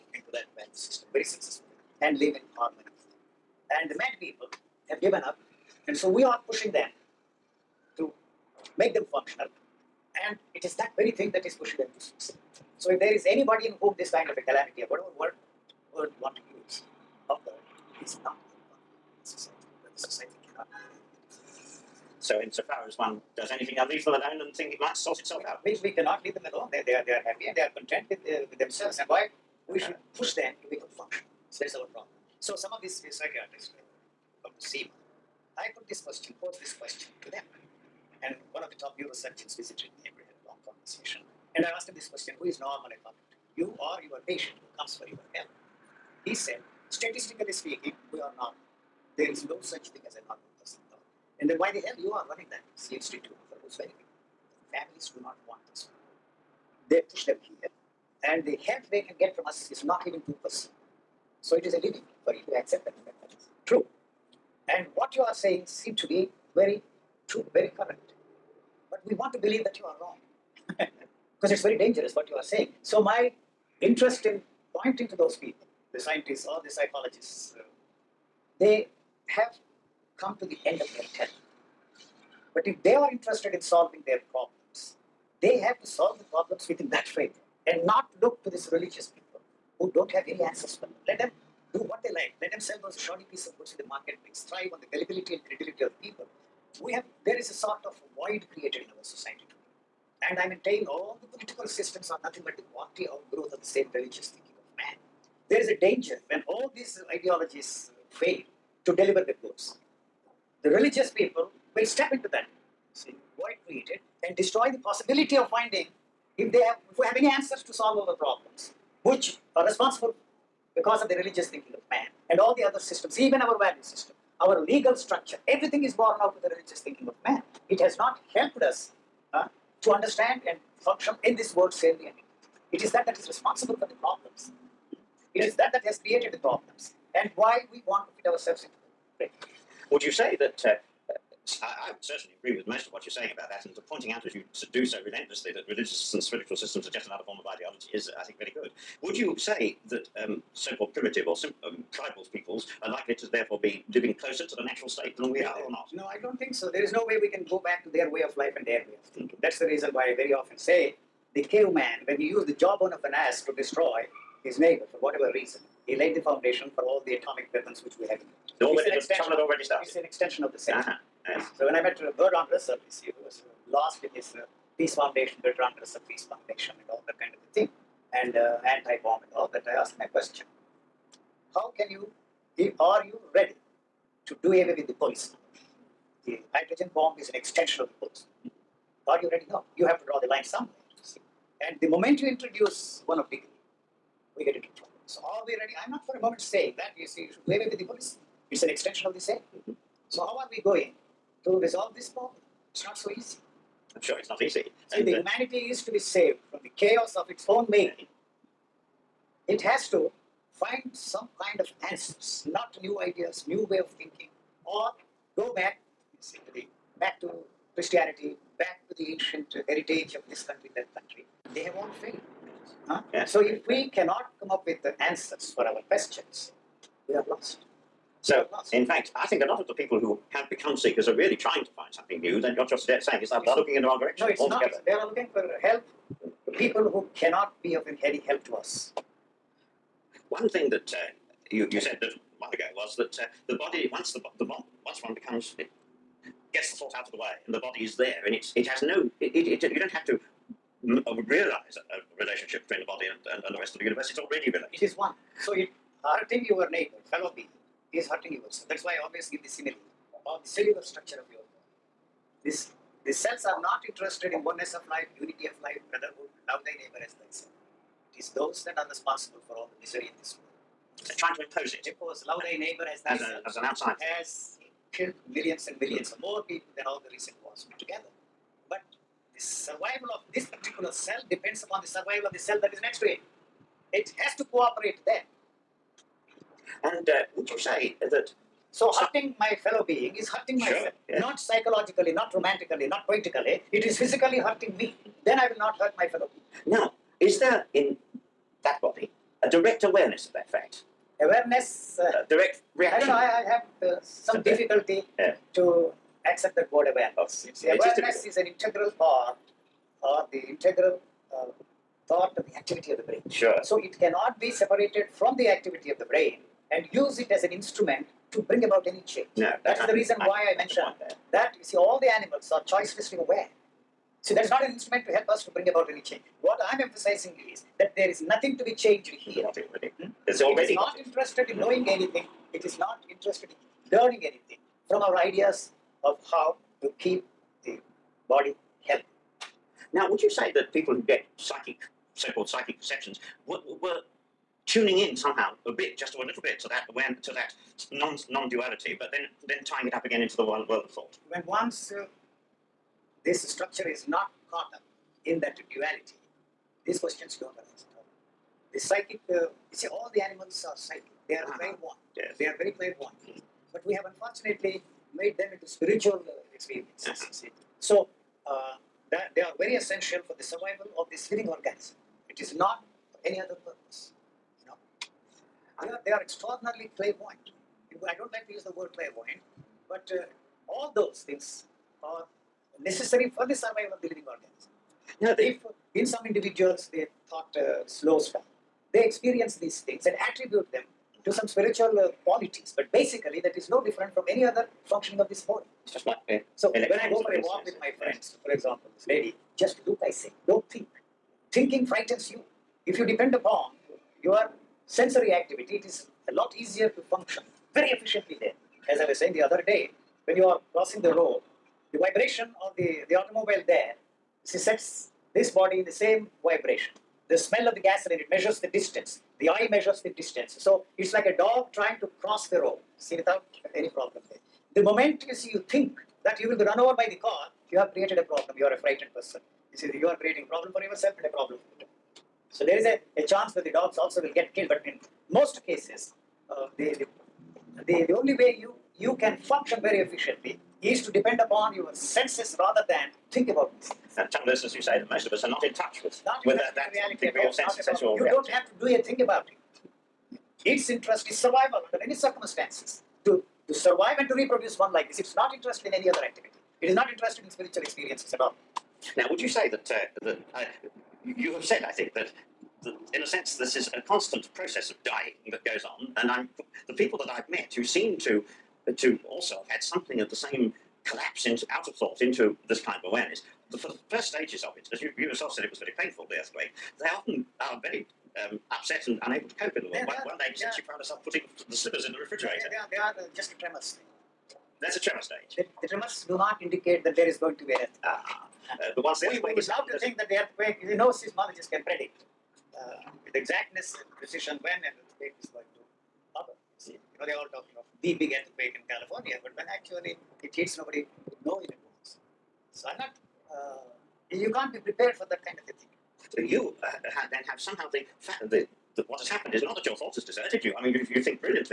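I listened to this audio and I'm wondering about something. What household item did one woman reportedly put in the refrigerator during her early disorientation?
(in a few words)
slippers.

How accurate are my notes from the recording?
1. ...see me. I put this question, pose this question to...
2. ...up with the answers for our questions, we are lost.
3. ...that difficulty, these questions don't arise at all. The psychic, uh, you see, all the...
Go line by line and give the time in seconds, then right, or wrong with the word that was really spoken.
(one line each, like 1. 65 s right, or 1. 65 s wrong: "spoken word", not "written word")
1. 34 s right
2. 224 s right
3. 355 s wrong: "duality", not "difficulty".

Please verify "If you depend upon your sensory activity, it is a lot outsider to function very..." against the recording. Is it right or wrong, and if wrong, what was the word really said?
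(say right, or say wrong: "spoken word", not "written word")
wrong: "easier", not "outsider".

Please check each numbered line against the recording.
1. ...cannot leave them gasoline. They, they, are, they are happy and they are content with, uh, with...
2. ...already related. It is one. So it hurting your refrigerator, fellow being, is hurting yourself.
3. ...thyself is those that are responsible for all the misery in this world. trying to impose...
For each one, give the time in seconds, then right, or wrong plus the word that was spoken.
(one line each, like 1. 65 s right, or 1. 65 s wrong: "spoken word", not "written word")
1. 25 s wrong: "alone", not "gasoline"
2. 254 s wrong: "neighbor", not "refrigerator"
3. 267 s right.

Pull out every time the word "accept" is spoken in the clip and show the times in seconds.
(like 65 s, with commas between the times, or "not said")
62 s, 306 s.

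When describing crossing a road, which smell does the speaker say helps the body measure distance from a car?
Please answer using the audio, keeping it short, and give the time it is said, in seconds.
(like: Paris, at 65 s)
gasoline, at 417 s.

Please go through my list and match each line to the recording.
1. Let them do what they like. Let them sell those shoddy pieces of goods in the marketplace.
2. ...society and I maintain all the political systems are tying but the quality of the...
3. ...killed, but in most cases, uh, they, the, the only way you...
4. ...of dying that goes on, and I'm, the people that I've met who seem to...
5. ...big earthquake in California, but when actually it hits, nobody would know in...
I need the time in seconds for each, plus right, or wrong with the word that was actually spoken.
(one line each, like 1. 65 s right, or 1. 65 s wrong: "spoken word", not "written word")
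1. 91 s right
2. 99 s wrong: "nothing", not "tying"
3. 434 s right
4. 464 s right
5. 498 s right.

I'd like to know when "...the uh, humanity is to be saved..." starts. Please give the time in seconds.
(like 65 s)
205 s.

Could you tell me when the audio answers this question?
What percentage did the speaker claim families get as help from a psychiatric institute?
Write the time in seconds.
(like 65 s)
60 s.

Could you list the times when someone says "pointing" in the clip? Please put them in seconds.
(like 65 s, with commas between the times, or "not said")
74 s, 143 s.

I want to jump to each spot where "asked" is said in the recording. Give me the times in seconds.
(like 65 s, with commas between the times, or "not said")
41 s, 179 s.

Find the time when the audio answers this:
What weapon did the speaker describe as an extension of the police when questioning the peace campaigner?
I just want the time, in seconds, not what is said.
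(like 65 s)
186 s.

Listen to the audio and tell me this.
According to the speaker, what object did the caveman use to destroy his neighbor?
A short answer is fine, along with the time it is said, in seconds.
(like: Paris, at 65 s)
jawbone of an ass, at 162 s.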